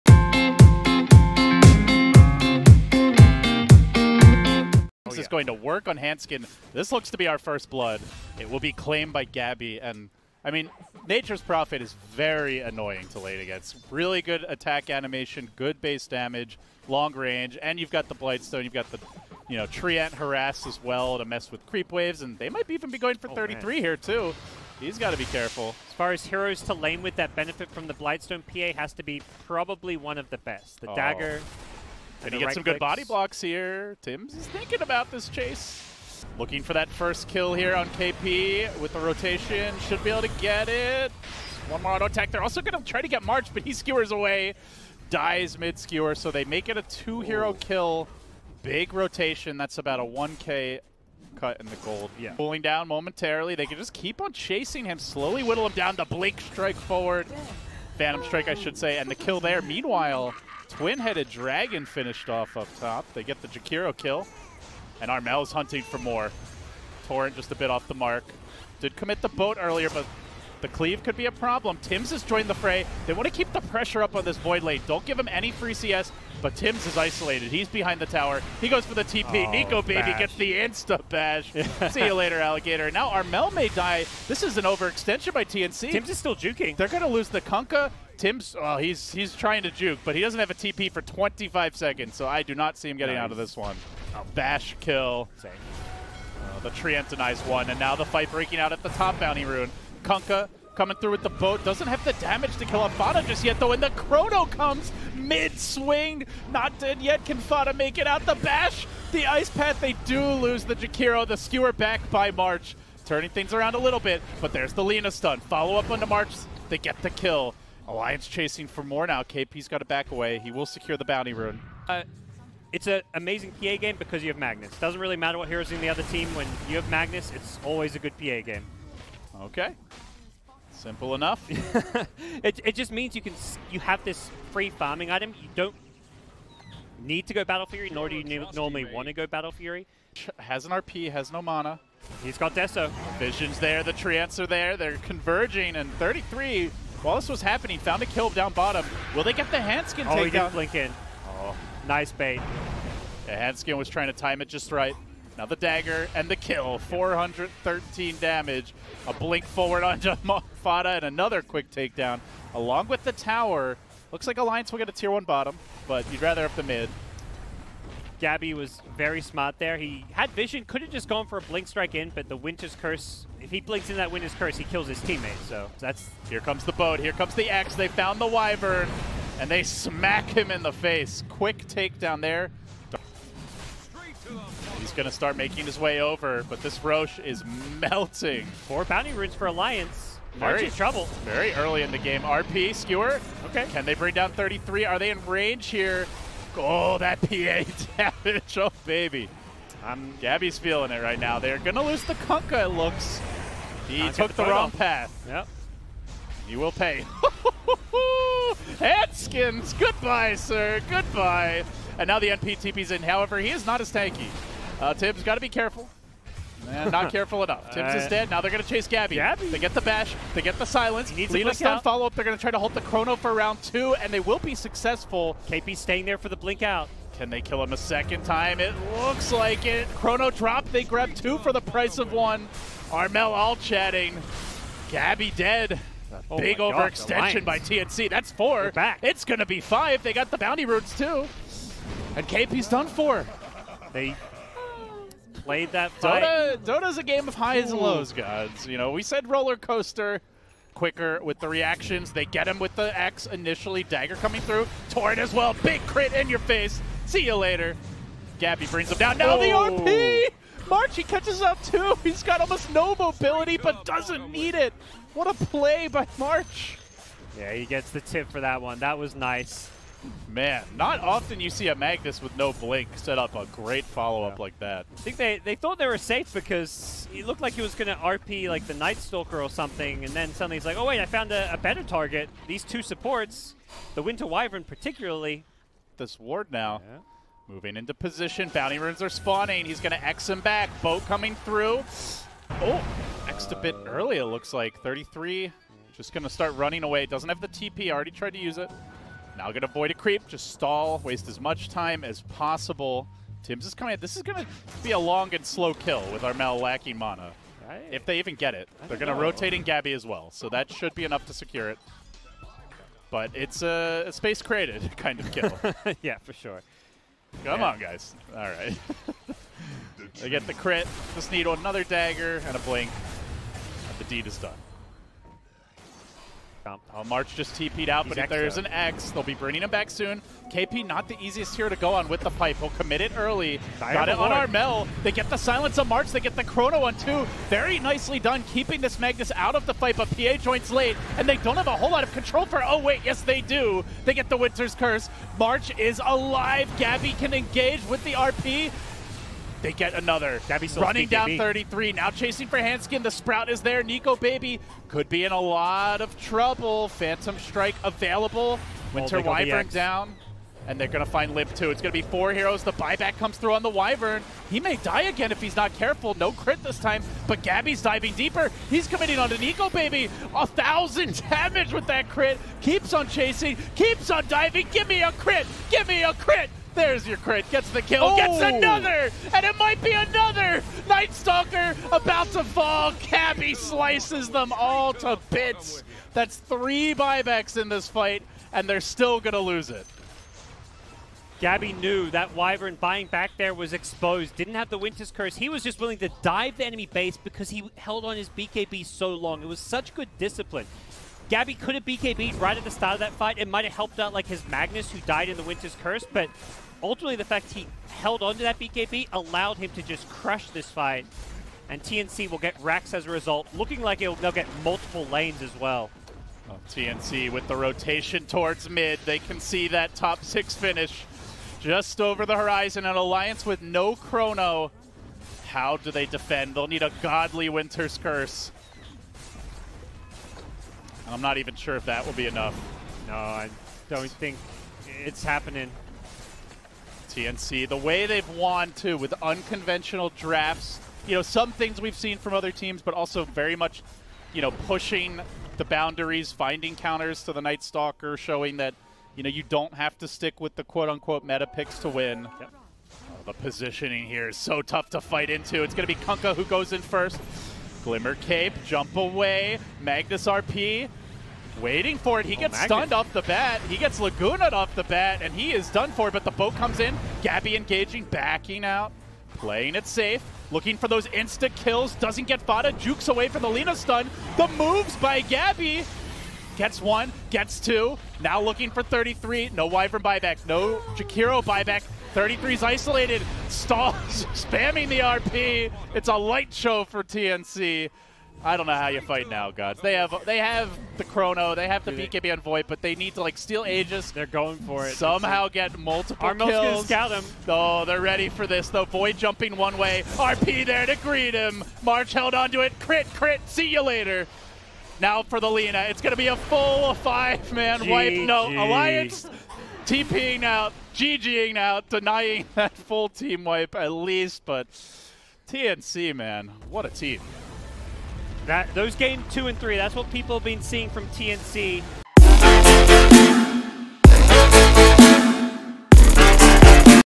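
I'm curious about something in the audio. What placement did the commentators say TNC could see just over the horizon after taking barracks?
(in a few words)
top 6.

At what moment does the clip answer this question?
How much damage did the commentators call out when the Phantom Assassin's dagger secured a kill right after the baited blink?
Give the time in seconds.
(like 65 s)
156 s.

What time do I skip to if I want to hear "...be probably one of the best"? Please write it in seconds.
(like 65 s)
29 s.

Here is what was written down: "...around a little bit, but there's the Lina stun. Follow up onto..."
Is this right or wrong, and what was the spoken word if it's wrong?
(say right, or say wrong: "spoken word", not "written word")
right.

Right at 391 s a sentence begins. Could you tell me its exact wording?
Gabbi knew that Wyvern buying back there was exposed, didn't have the Winter's Curse.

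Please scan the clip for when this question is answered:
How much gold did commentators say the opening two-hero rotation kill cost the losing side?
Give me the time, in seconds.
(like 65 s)
50 s.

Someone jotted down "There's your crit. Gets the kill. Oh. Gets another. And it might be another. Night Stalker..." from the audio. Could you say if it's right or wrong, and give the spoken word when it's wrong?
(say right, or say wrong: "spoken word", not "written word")
right.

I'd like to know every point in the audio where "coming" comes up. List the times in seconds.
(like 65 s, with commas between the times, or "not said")
100 s, 254 s, 291 s, 303 s.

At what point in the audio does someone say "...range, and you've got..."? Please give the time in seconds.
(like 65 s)
17 s.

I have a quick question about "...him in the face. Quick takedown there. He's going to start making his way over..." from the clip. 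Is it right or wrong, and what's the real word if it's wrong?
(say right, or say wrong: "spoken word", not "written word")
right.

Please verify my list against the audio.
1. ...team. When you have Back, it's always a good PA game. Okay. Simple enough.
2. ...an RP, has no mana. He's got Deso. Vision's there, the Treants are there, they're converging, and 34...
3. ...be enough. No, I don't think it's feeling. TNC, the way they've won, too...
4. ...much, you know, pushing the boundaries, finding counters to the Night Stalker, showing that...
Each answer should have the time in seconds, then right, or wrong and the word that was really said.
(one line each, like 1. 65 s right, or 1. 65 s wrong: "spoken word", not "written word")
1. 126 s wrong: "Magnus", not "Back"
2. 140 s wrong: "33", not "34"
3. 432 s wrong: "happening", not "feeling"
4. 443 s right.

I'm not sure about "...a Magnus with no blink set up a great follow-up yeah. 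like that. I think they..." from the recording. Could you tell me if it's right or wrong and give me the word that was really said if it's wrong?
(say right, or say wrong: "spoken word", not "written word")
right.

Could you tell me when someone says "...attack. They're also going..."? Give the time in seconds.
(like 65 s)
42 s.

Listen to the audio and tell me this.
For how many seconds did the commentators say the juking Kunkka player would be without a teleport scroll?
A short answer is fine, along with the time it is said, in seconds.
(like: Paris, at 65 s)
25, at 91 s.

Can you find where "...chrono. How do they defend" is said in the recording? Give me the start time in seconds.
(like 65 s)
423 s.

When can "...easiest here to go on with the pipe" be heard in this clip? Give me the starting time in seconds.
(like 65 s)
331 s.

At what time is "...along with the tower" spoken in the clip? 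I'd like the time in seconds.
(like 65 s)
162 s.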